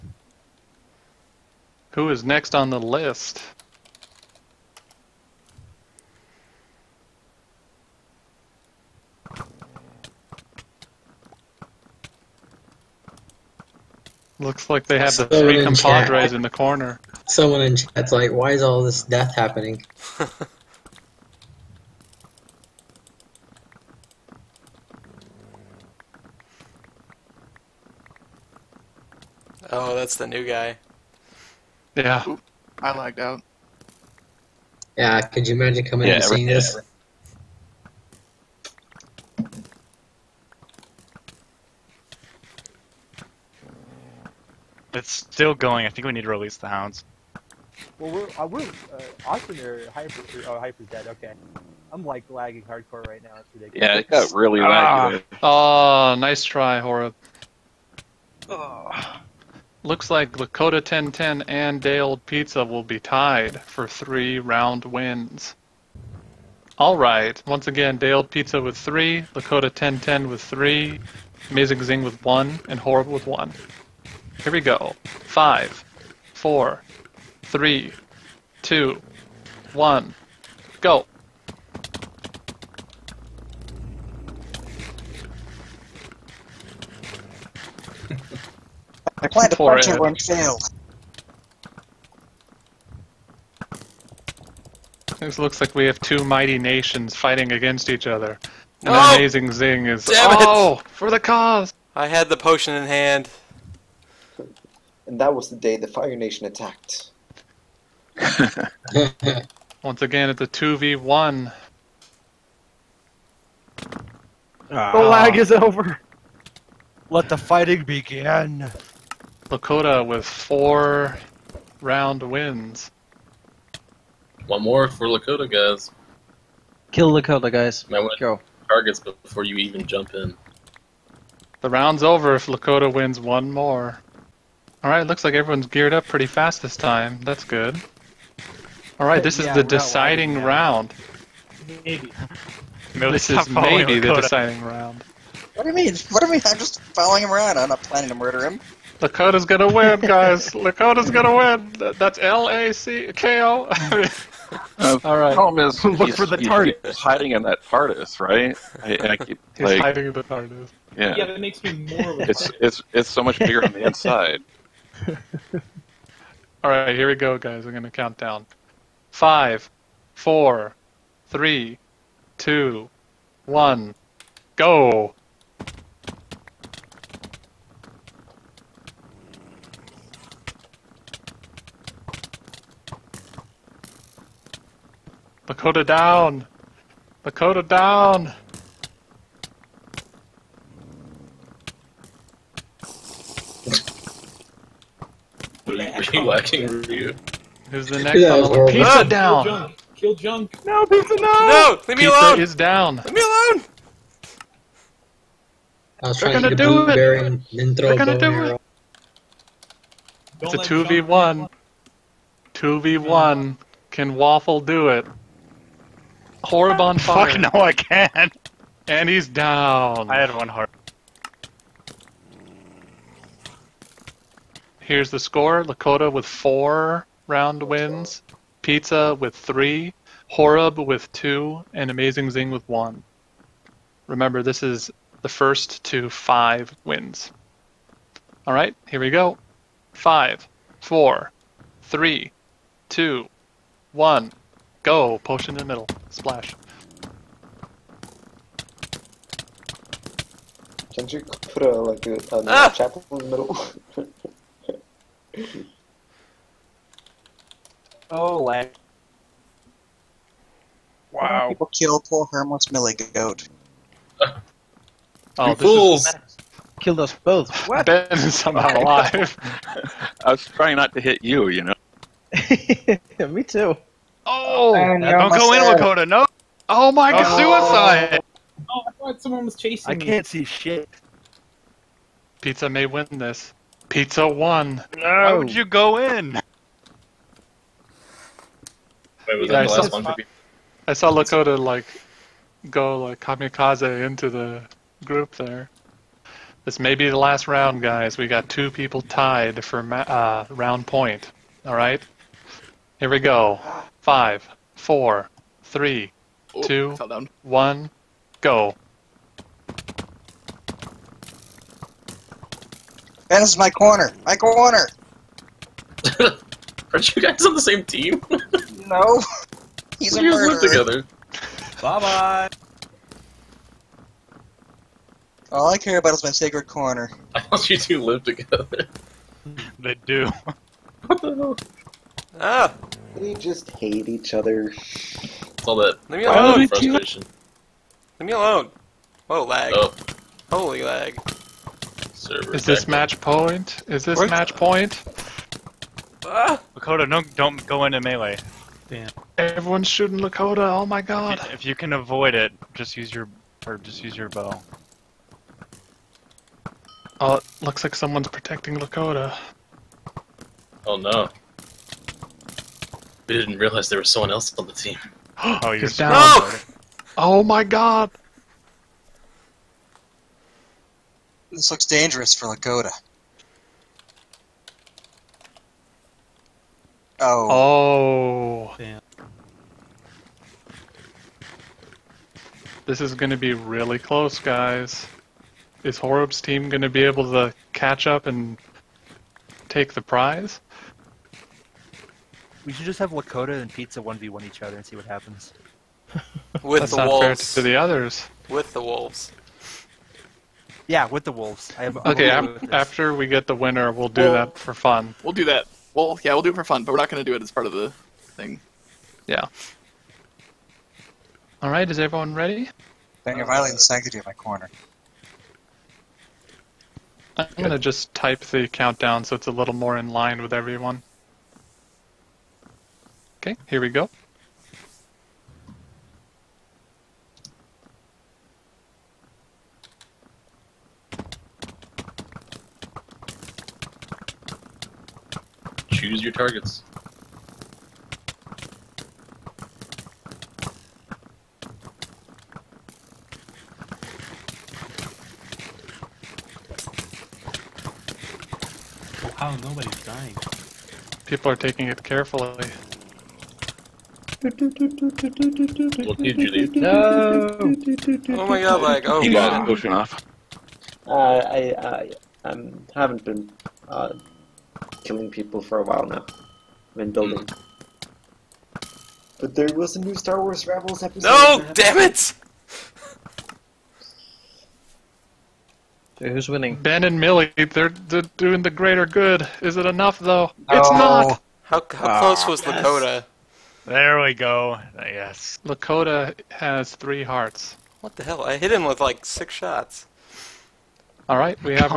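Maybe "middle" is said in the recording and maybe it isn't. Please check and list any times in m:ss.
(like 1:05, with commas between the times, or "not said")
4:05, 4:13.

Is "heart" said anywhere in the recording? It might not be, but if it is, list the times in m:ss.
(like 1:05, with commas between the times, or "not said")
3:40, 8:07.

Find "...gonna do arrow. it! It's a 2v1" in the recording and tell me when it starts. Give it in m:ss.
3:27.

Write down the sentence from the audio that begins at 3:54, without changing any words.
Remember, this is the first to five wins.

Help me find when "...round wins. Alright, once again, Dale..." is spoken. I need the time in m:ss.
1:04.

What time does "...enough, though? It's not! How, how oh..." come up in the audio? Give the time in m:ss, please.
7:59.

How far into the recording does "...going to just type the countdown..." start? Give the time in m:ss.
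6:57.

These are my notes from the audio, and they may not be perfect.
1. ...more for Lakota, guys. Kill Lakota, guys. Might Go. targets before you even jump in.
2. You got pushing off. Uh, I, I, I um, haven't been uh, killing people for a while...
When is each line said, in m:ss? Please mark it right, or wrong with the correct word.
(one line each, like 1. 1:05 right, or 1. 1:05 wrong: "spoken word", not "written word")
1. 2:04 right
2. 7:39 right.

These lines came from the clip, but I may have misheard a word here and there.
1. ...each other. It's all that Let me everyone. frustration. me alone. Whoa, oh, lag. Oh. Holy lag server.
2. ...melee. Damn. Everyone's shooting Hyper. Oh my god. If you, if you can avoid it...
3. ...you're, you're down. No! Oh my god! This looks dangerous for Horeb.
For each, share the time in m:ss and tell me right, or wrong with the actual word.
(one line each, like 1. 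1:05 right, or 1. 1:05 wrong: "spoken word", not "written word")
1. 5:34 wrong: "alone", not "everyone"
2. 5:47 wrong: "Lakota", not "Hyper"
3. 6:05 wrong: "Lakota", not "Horeb".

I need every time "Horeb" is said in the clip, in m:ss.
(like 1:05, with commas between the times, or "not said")
0:56, 1:12, 3:50, 6:25.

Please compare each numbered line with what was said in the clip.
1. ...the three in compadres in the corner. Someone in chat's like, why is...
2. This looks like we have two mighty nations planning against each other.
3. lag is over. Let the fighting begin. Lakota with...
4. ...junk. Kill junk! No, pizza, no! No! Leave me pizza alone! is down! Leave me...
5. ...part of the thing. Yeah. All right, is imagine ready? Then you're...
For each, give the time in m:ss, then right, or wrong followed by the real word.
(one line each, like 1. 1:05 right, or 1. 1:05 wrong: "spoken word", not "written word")
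1. 0:15 right
2. 1:35 wrong: "fighting", not "planning"
3. 1:55 right
4. 3:19 right
5. 6:47 wrong: "everyone", not "imagine".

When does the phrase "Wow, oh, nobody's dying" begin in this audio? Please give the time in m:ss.
7:29.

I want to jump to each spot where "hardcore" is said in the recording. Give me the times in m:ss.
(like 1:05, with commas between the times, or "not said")
0:52.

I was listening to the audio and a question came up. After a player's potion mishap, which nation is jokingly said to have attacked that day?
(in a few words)
Fire Nation.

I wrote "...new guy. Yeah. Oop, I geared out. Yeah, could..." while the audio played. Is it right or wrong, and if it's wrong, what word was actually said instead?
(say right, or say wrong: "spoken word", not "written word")
wrong: "lagged", not "geared".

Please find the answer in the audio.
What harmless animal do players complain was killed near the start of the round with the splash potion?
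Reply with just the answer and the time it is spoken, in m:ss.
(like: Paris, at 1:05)
Millie Goat, at 4:22.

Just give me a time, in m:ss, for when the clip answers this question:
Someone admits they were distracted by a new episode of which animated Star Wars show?
7:50.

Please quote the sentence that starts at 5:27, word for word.
I thought you two live together.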